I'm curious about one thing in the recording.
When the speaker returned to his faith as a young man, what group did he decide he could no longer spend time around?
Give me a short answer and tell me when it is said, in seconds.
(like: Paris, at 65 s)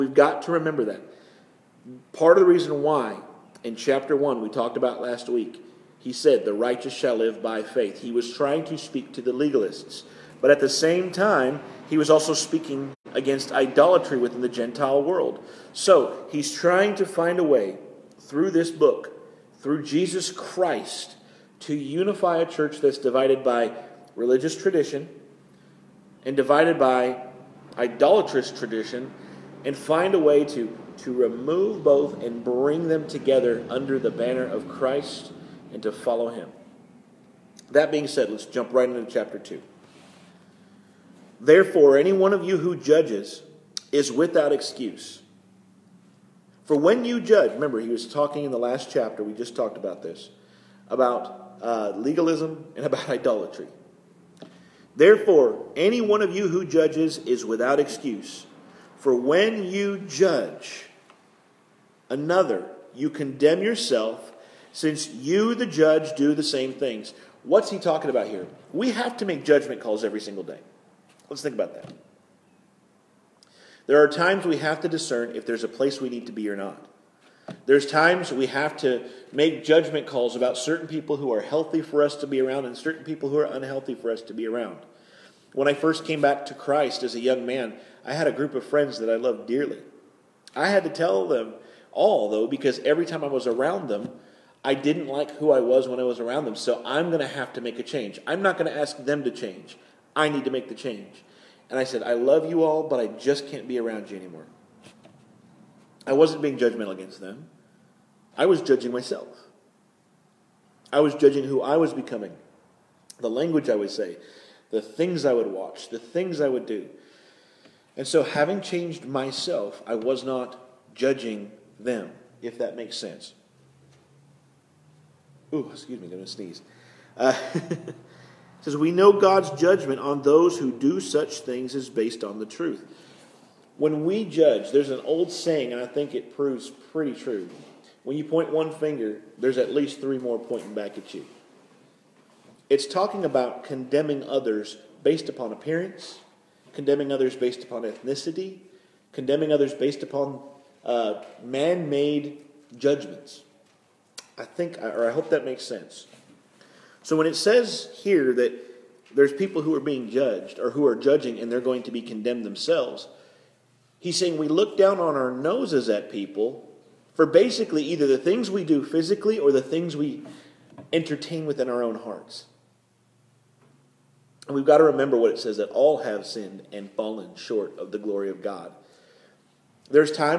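A group of friends, at 88 s.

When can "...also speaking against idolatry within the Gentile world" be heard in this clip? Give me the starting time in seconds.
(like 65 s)
12 s.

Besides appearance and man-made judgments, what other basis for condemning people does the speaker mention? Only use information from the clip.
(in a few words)
Ethnicity.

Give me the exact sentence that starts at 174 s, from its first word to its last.
And we've got to remember what it says that all have sinned and fallen short of the glory of God.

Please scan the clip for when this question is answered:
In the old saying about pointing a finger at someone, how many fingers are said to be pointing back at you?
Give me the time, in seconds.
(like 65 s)
139 s.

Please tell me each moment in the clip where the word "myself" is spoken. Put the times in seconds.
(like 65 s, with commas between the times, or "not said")
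108 s, 119 s.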